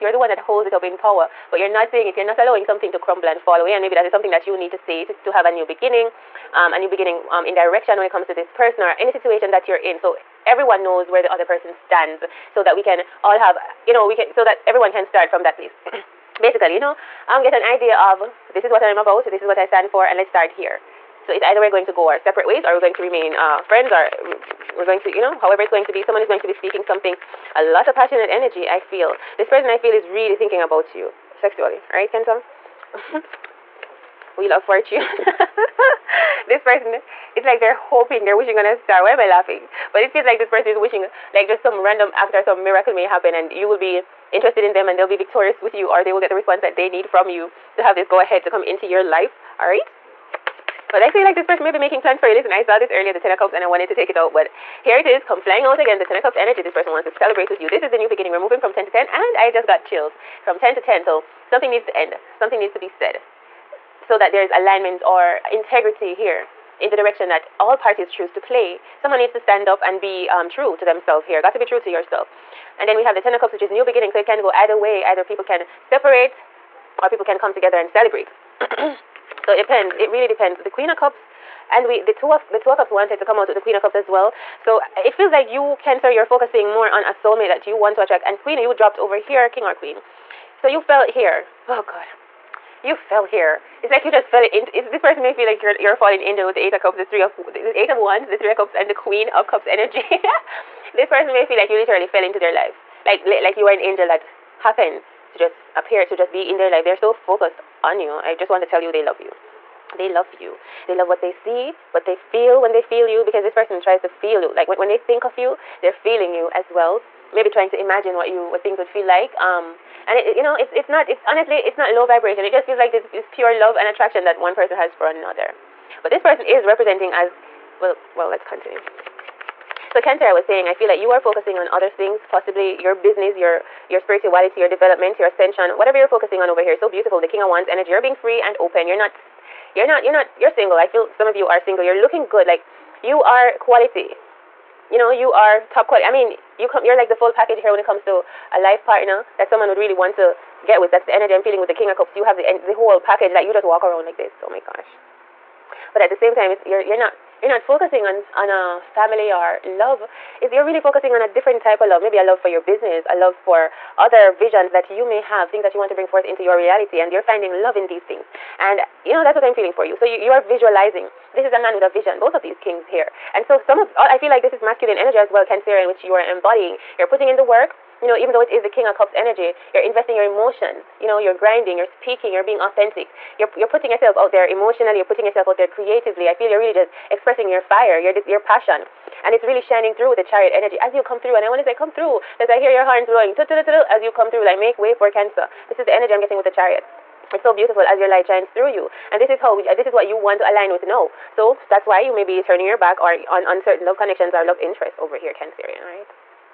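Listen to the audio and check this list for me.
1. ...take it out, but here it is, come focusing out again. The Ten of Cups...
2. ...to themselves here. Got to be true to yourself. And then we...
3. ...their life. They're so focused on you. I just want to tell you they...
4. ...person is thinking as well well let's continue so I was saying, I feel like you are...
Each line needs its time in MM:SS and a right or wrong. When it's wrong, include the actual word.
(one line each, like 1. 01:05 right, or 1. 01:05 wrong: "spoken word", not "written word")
1. 00:53 wrong: "flying", not "focusing"
2. 01:10 right
3. 01:46 right
4. 02:06 wrong: "representing", not "thinking".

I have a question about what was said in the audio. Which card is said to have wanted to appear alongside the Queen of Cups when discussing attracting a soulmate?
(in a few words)
Two of Cups.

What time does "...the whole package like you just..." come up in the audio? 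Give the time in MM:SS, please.
02:32.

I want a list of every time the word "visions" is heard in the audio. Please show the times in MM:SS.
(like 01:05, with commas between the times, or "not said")
02:44, 02:51.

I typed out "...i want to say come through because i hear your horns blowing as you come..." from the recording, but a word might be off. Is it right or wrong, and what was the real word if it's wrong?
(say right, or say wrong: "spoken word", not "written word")
right.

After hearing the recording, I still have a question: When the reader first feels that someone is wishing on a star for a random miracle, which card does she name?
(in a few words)
Wheel of Fortune.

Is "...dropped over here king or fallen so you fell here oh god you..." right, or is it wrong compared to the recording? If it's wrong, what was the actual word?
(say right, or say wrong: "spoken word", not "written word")
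wrong: "queen", not "fallen".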